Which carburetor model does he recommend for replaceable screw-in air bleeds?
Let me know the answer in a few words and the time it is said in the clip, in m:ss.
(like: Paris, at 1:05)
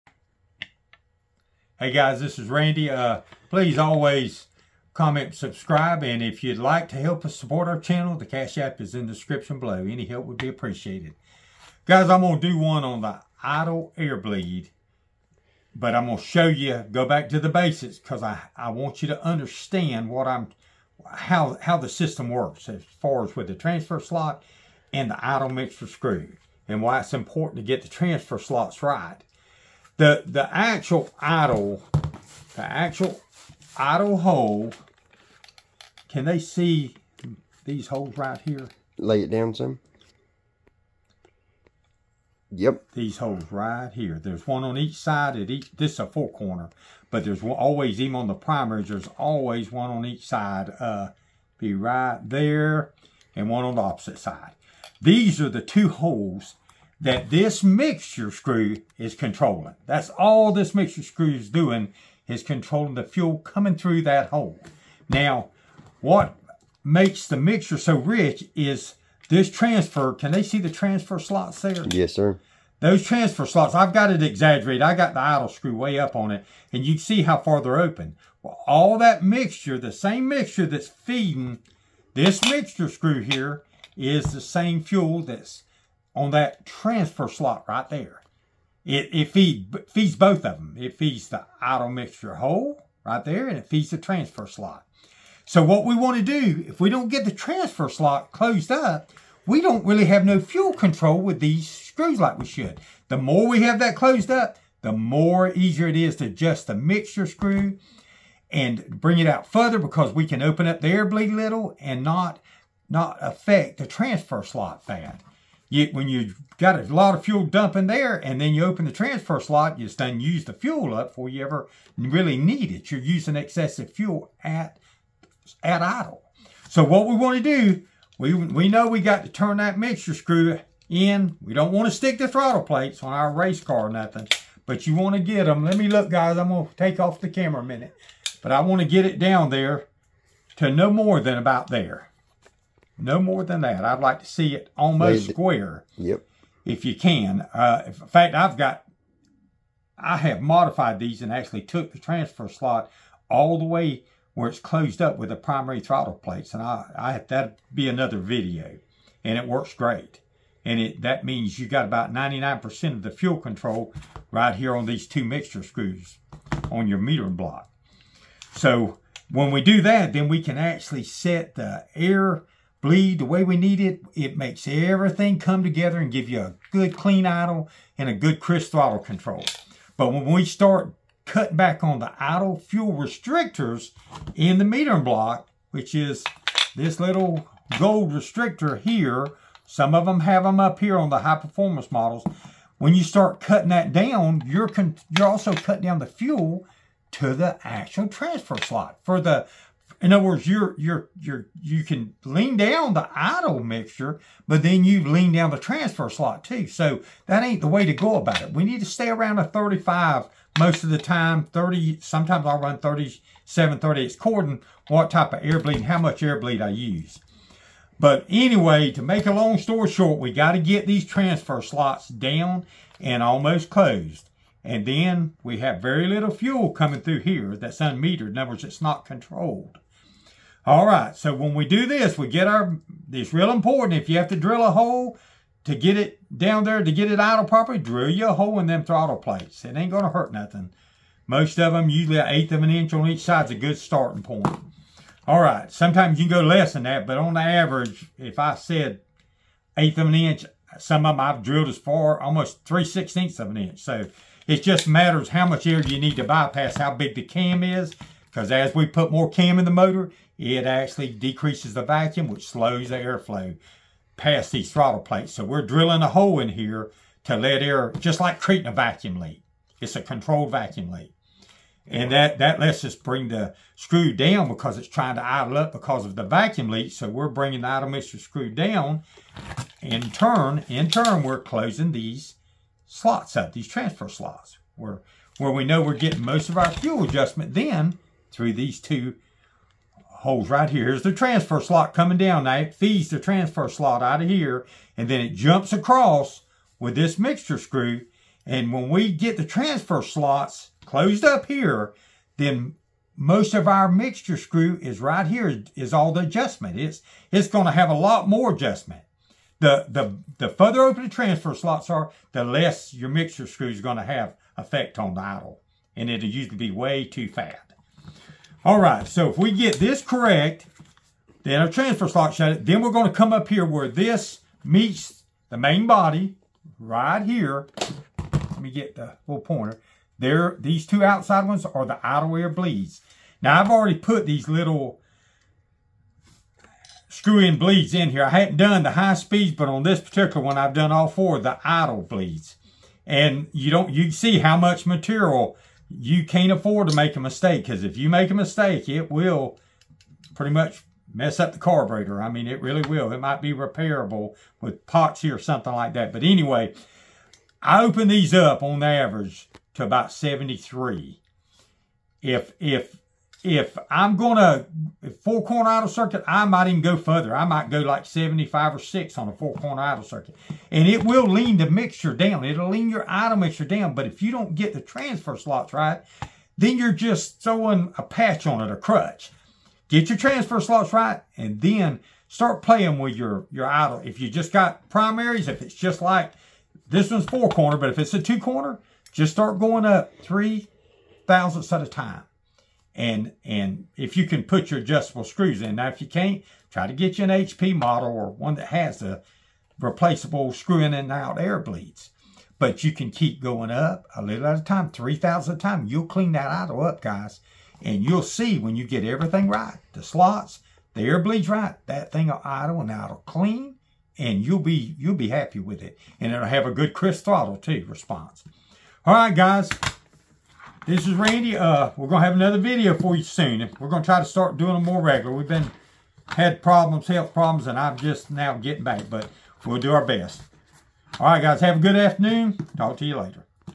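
HP model, at 6:37.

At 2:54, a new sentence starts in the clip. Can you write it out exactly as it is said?
It makes everything come together and give you a good clean idle and a good crisp throttle control.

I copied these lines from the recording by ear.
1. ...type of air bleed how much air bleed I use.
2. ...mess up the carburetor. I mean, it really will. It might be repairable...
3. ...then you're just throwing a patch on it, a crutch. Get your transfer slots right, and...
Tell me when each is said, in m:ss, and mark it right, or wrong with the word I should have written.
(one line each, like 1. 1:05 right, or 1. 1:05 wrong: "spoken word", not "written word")
1. 3:35 right
2. 5:51 right
3. 6:16 right.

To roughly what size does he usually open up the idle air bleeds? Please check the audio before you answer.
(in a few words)
73.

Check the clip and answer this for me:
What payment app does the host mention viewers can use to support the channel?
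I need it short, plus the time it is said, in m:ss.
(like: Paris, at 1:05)
Cash App, at 0:08.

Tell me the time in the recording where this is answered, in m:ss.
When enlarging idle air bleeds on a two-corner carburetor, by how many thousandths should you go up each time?
6:30.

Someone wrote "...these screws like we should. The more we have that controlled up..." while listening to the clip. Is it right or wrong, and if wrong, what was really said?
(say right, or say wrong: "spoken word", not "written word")
wrong: "closed", not "controlled".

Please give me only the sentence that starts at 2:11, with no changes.
We don't want to stick the throttle plates on our race car or nothing, but you want to get them.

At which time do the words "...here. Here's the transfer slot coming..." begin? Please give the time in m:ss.
4:50.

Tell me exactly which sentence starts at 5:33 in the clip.
Now, I've already put these little screw-in bleeds in here.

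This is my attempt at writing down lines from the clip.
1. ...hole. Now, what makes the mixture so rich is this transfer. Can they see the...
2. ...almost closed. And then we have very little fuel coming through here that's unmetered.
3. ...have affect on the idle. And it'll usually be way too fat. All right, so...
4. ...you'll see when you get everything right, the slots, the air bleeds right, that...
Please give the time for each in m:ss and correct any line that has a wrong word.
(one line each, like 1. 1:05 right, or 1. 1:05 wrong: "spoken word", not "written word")
1. 1:04 right
2. 3:43 right
3. 5:14 wrong: "effect", not "affect"
4. 6:48 right.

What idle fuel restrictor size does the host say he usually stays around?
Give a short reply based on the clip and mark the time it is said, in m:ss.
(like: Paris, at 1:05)
35, at 3:29.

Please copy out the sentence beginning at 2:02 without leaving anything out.
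You're using excessive fuel at, at idle.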